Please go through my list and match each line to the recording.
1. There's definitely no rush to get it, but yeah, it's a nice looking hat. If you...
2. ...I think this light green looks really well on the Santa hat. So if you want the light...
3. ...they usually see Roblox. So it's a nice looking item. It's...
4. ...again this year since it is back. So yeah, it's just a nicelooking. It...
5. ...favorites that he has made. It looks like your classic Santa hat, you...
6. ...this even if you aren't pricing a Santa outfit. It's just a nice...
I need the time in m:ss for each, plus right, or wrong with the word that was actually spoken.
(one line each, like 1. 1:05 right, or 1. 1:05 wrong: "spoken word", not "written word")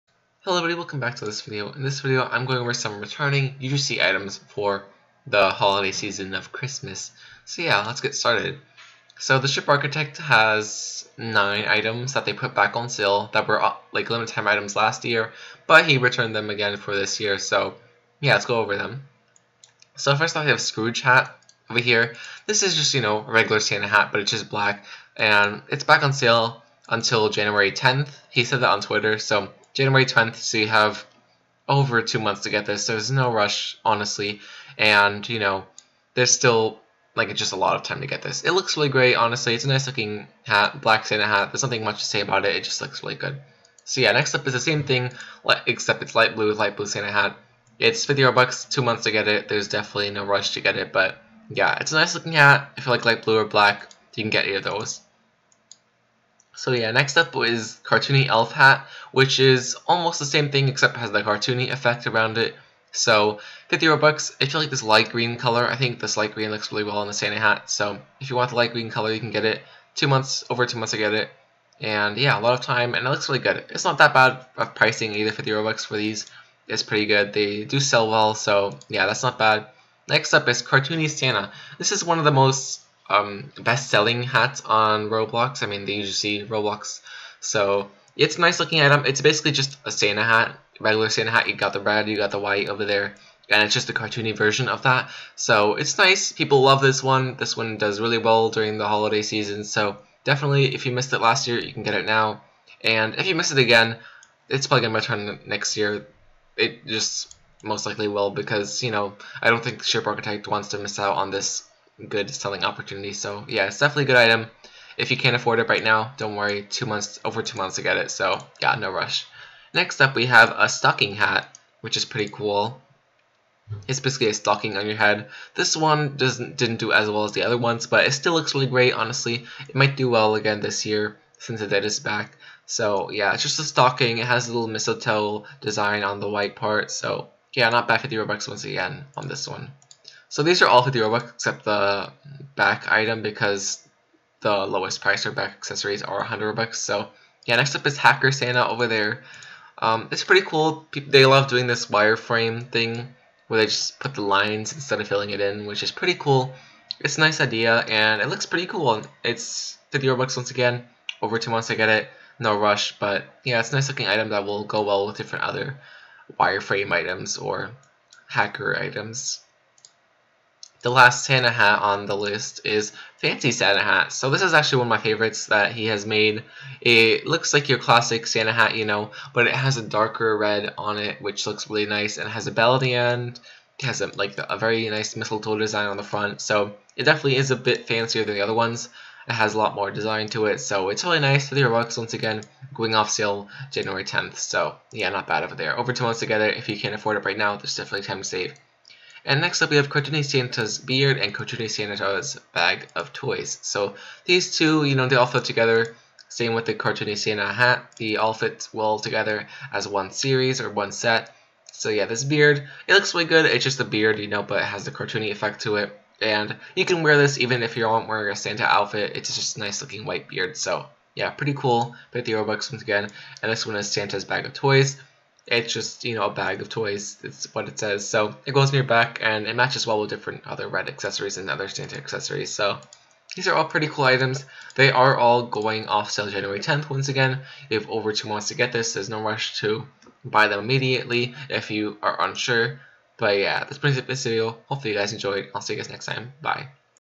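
1. 0:49 right
2. 1:05 right
3. 1:25 right
4. 2:10 wrong: "stocking", not "nicelooking"
5. 2:54 right
6. 3:37 wrong: "wearing", not "pricing".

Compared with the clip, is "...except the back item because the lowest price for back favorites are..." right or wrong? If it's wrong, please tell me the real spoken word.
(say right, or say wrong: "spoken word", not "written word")
wrong: "accessories", not "favorites".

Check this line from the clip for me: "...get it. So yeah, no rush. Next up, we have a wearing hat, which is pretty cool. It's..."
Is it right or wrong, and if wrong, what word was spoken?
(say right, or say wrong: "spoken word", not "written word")
wrong: "stocking", not "wearing".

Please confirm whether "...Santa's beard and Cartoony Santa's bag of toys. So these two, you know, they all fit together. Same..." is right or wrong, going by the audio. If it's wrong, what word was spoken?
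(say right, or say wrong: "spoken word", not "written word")
right.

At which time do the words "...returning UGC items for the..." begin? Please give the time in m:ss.
0:02.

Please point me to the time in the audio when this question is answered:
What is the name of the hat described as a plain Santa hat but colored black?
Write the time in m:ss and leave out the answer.
0:20.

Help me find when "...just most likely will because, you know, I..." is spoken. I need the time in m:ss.
1:46.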